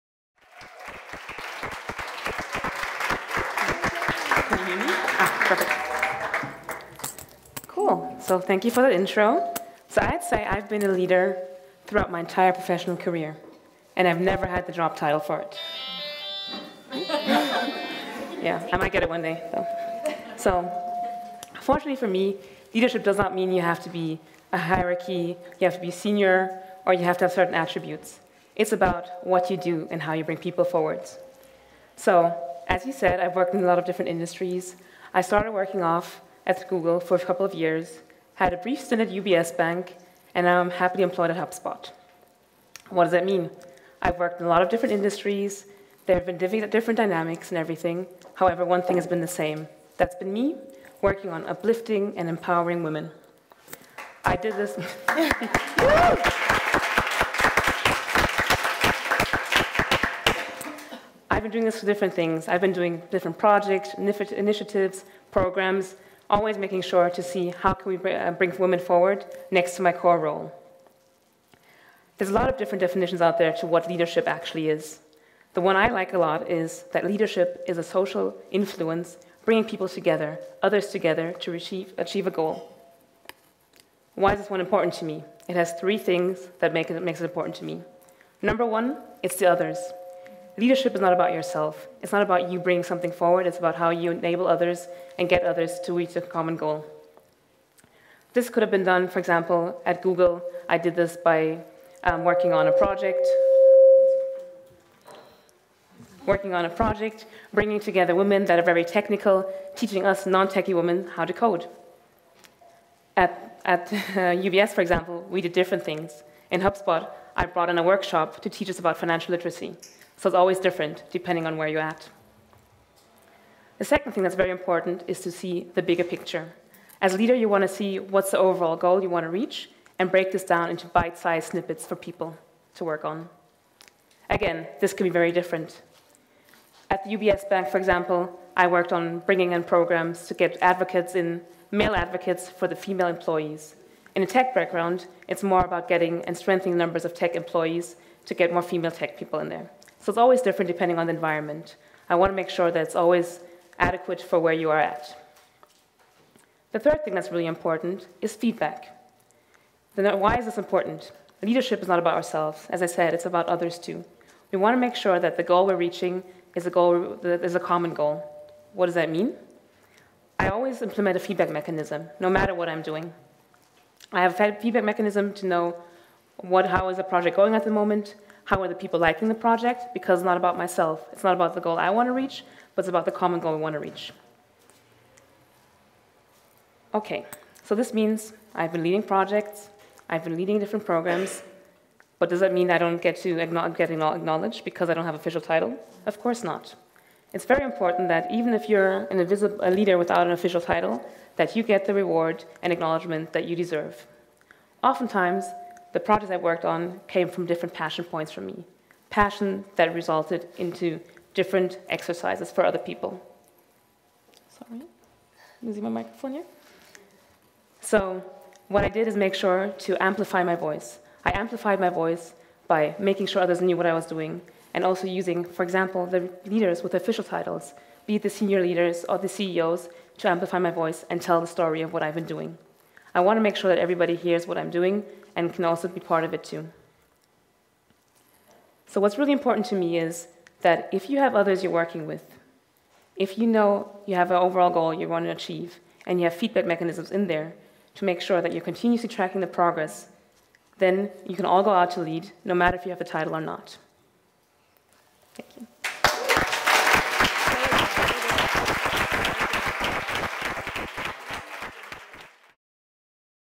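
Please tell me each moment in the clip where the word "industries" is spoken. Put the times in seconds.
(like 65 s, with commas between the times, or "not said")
34 s, 44 s.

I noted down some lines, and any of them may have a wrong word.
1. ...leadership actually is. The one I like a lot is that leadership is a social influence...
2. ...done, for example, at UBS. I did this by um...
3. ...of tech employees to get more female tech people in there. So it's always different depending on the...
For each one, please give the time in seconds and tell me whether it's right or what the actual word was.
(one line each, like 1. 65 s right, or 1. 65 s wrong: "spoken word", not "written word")
1. 73 s right
2. 98 s wrong: "Google", not "UBS"
3. 147 s right.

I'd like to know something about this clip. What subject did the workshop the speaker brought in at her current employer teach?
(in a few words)
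Financial literacy.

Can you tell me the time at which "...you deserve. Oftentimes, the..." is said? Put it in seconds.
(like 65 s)
203 s.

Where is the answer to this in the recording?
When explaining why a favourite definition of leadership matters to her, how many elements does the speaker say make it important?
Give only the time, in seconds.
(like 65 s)
85 s.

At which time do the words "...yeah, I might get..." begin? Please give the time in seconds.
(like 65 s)
18 s.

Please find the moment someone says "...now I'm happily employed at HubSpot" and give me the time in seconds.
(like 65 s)
40 s.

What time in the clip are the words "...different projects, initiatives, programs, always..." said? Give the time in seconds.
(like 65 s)
63 s.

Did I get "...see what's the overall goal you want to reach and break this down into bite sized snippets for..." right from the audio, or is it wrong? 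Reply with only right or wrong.
right.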